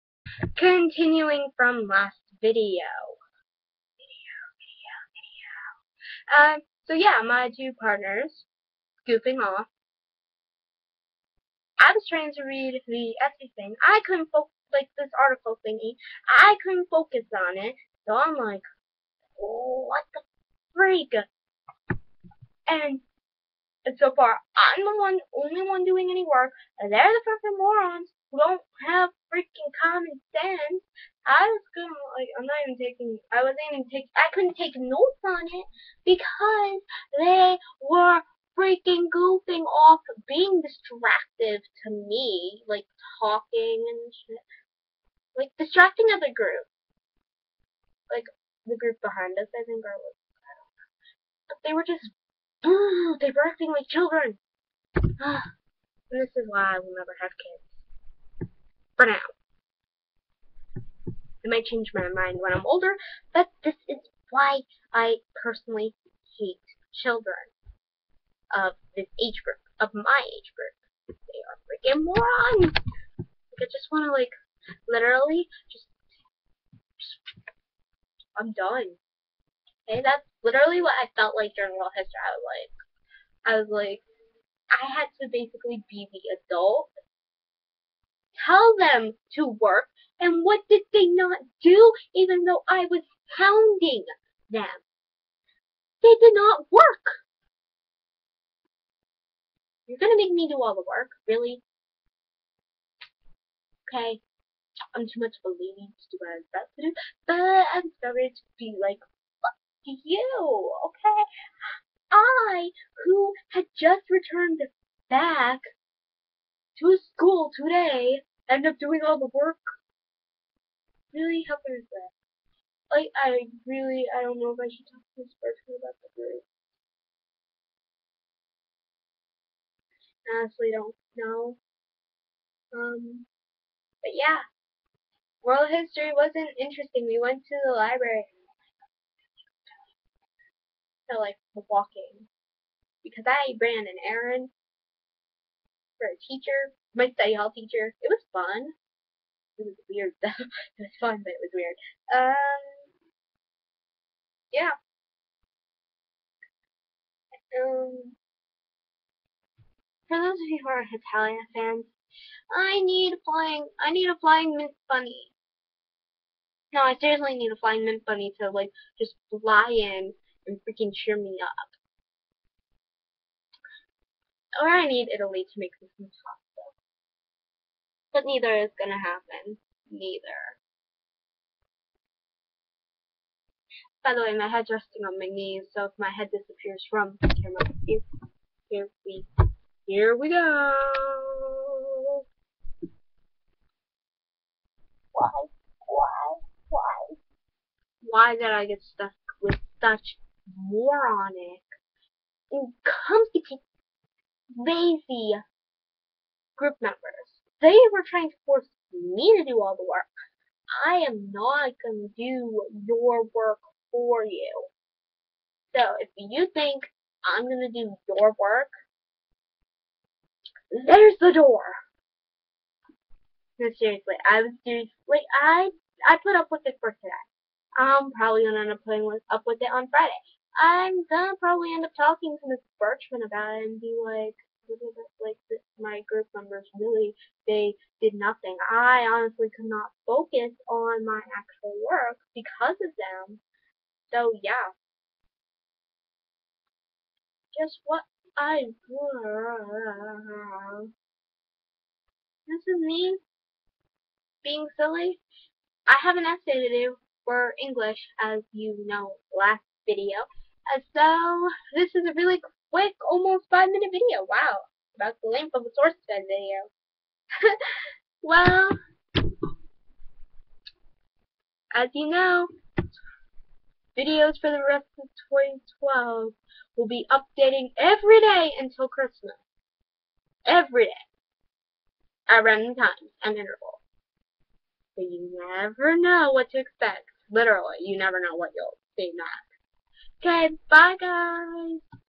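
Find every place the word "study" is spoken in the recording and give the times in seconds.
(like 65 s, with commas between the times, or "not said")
147 s.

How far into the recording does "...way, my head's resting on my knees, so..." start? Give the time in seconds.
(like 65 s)
184 s.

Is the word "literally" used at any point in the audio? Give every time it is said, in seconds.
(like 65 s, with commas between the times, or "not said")
74 s, 80 s, 287 s.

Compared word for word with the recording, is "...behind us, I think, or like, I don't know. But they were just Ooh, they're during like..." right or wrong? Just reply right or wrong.
wrong.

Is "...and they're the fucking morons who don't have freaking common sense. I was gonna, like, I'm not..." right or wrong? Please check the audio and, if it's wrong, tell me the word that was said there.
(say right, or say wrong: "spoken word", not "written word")
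right.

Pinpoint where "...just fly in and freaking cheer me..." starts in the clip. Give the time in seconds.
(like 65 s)
168 s.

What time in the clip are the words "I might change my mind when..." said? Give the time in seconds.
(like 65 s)
61 s.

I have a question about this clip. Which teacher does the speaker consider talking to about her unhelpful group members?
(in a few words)
Miss Birchman.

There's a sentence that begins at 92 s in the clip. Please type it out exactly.
Even though I was pounding them, they did not work.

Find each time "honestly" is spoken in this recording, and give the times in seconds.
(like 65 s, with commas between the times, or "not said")
130 s, 239 s.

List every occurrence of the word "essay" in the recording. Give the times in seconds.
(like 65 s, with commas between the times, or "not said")
13 s, 256 s.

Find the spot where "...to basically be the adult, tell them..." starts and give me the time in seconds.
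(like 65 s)
85 s.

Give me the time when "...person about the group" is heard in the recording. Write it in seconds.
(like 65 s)
125 s.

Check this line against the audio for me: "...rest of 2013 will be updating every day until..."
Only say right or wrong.
wrong.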